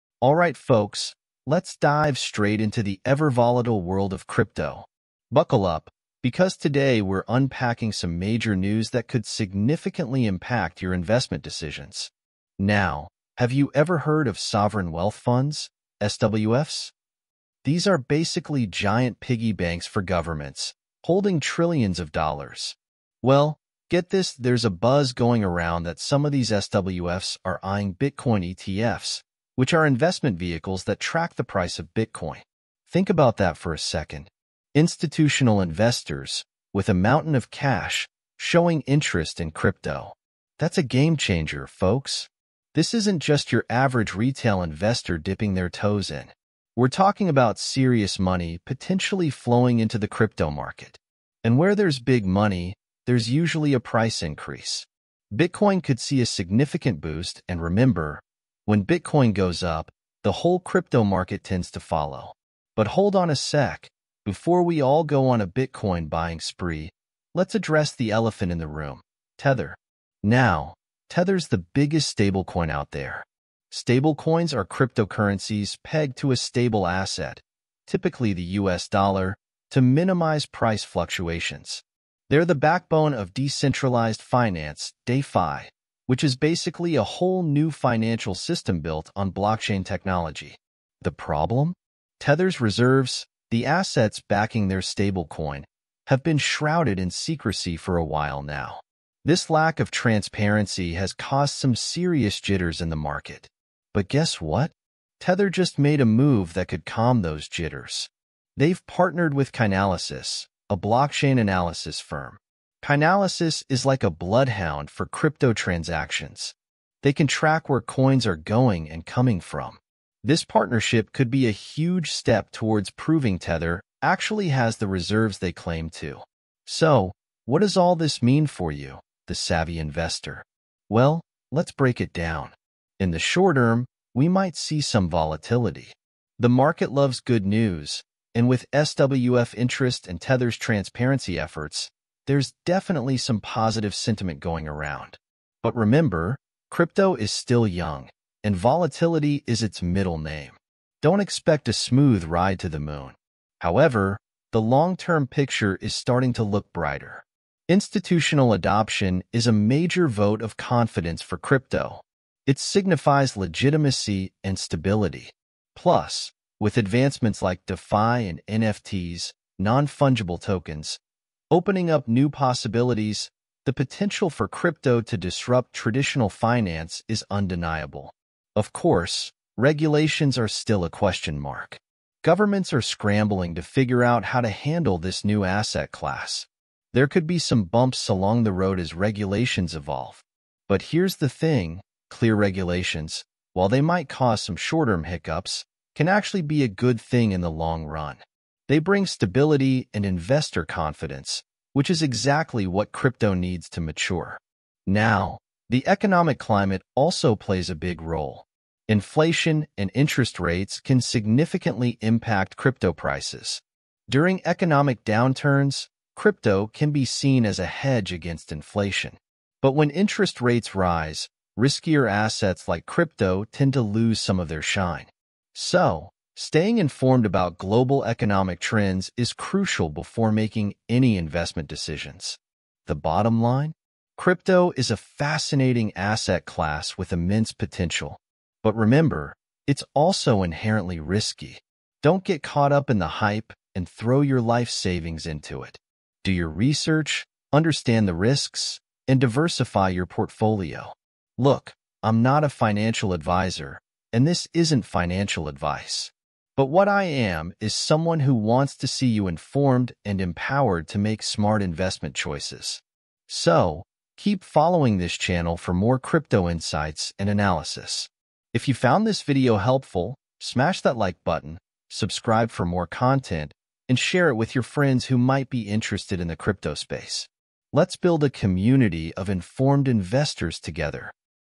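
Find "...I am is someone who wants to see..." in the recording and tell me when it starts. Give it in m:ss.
4:16.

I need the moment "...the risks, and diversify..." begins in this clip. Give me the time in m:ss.
4:08.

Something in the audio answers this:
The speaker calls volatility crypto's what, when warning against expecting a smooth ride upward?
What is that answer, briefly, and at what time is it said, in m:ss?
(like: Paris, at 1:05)
middle name, at 2:29.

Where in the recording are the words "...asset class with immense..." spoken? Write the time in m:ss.
3:55.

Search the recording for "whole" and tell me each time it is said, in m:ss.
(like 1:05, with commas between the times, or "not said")
1:00, 1:27.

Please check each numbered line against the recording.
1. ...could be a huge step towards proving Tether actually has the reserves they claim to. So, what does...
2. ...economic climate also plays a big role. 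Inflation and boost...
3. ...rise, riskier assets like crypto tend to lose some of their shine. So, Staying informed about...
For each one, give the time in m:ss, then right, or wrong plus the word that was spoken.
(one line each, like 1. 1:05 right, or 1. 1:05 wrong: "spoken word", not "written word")
1. 2:01 right
2. 3:25 wrong: "interest", not "boost"
3. 3:40 right.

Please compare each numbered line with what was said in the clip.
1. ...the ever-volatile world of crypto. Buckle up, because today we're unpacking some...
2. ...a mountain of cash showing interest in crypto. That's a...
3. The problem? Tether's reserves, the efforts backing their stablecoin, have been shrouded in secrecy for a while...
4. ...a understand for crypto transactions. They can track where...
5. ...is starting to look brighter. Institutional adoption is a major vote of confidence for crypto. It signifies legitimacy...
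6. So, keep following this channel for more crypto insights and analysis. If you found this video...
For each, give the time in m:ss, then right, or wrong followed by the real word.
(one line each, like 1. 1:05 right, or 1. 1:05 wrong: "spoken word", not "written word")
1. 0:02 right
2. 0:36 right
3. 1:31 wrong: "assets", not "efforts"
4. 1:54 wrong: "bloodhound", not "understand"
5. 2:35 right
6. 4:23 right.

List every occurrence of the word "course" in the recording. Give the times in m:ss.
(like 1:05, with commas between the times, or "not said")
2:58.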